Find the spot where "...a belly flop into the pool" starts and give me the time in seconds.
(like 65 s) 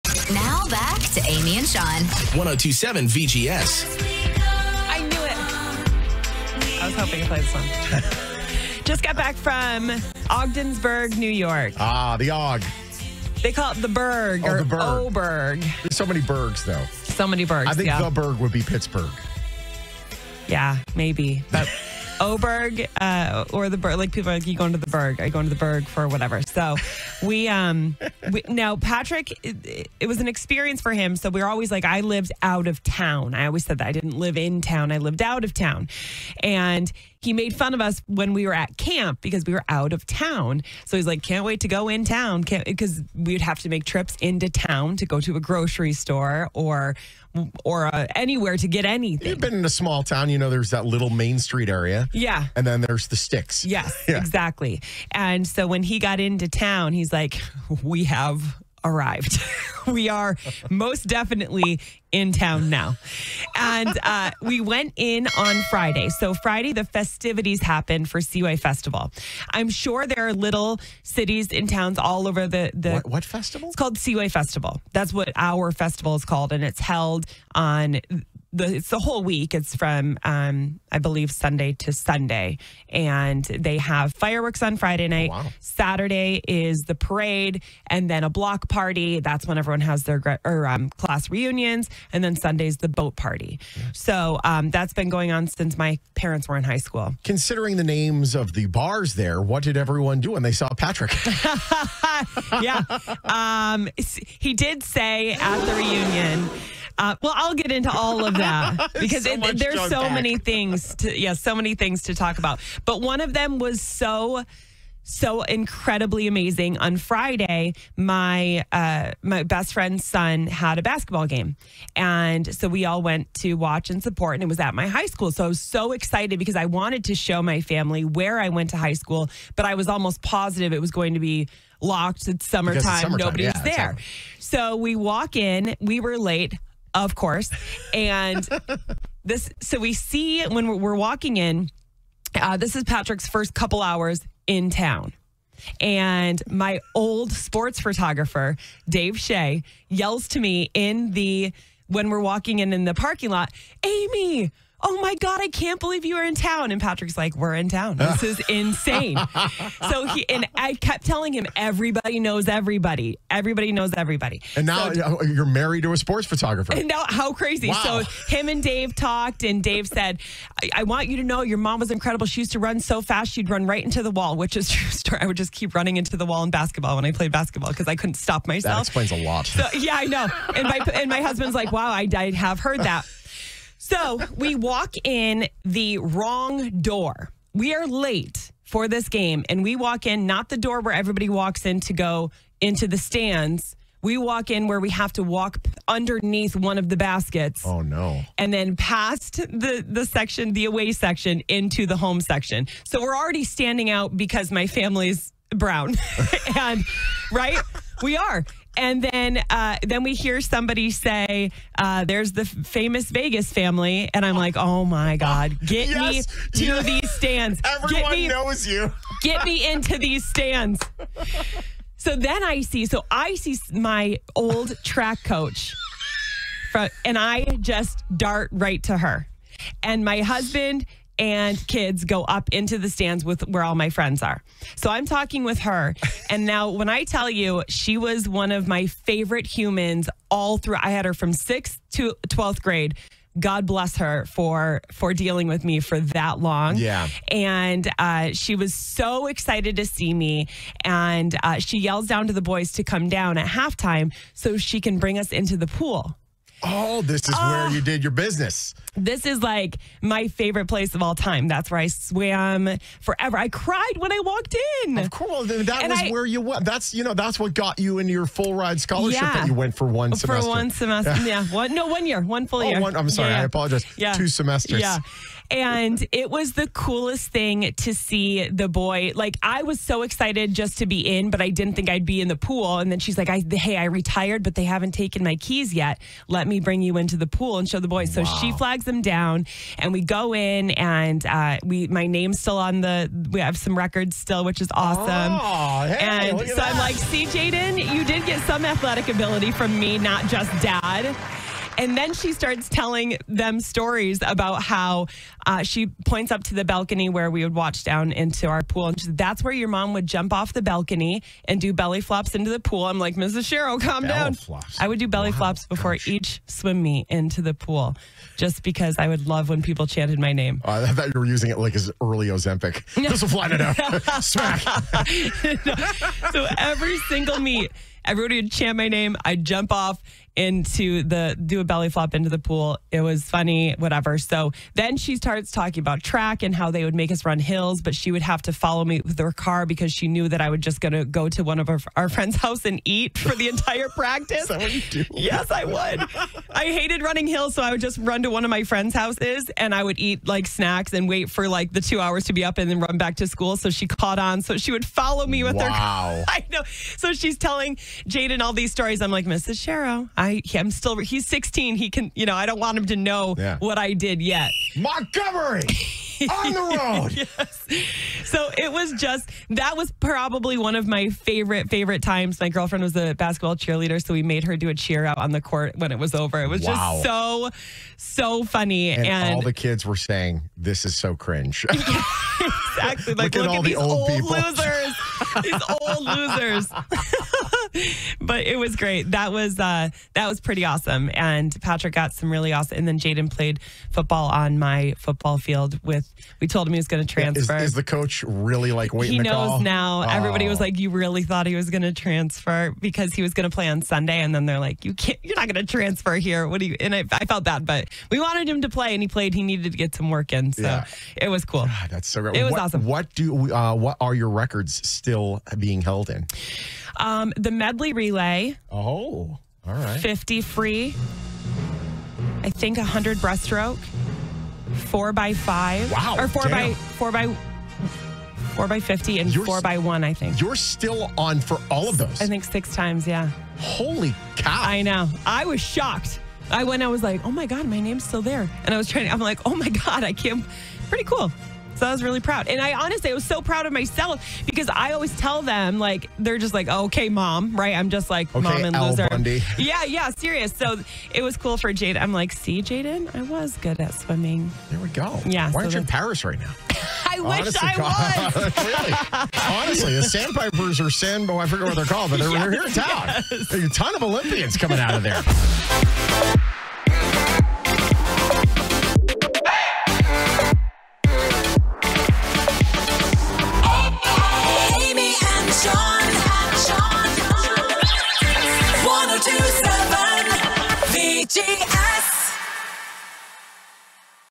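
331 s.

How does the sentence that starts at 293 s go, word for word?
We have some records still, which is awesome.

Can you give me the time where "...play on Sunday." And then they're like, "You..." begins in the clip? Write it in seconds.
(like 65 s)
403 s.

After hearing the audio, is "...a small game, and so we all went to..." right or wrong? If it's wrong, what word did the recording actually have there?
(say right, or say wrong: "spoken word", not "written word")
wrong: "basketball", not "small".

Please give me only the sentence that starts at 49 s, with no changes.
You've been in a small town, you know, there's that little Main Street area.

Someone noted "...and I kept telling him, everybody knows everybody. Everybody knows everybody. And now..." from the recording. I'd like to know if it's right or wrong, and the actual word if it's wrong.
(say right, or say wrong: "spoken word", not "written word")
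right.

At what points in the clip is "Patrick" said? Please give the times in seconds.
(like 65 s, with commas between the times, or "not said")
28 s, 100 s, 142 s, 156 s, 391 s.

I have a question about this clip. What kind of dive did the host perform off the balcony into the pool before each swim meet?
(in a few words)
belly flops.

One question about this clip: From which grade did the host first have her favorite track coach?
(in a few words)
6th.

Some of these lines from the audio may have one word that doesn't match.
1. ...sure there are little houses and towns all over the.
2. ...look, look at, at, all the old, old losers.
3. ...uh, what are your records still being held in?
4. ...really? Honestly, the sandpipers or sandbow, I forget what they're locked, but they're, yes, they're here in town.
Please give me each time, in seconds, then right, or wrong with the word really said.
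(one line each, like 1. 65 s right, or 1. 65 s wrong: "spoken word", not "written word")
1. 69 s wrong: "cities", not "houses"
2. 383 s right
3. 413 s right
4. 458 s wrong: "called", not "locked".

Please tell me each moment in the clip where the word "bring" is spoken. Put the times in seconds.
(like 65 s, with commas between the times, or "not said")
254 s, 286 s.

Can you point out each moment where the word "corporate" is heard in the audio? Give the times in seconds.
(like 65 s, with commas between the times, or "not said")
not said.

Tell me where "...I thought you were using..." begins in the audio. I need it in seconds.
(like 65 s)
320 s.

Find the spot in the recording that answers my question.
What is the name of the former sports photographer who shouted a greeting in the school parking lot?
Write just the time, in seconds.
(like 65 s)
148 s.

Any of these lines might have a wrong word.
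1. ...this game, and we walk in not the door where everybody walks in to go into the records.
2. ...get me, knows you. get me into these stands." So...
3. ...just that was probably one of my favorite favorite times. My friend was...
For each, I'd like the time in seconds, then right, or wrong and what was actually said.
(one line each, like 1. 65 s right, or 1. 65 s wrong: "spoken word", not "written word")
1. 188 s wrong: "stands", not "records"
2. 218 s right
3. 368 s wrong: "girlfriend", not "friend".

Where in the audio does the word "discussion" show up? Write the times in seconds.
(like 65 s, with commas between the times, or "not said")
not said.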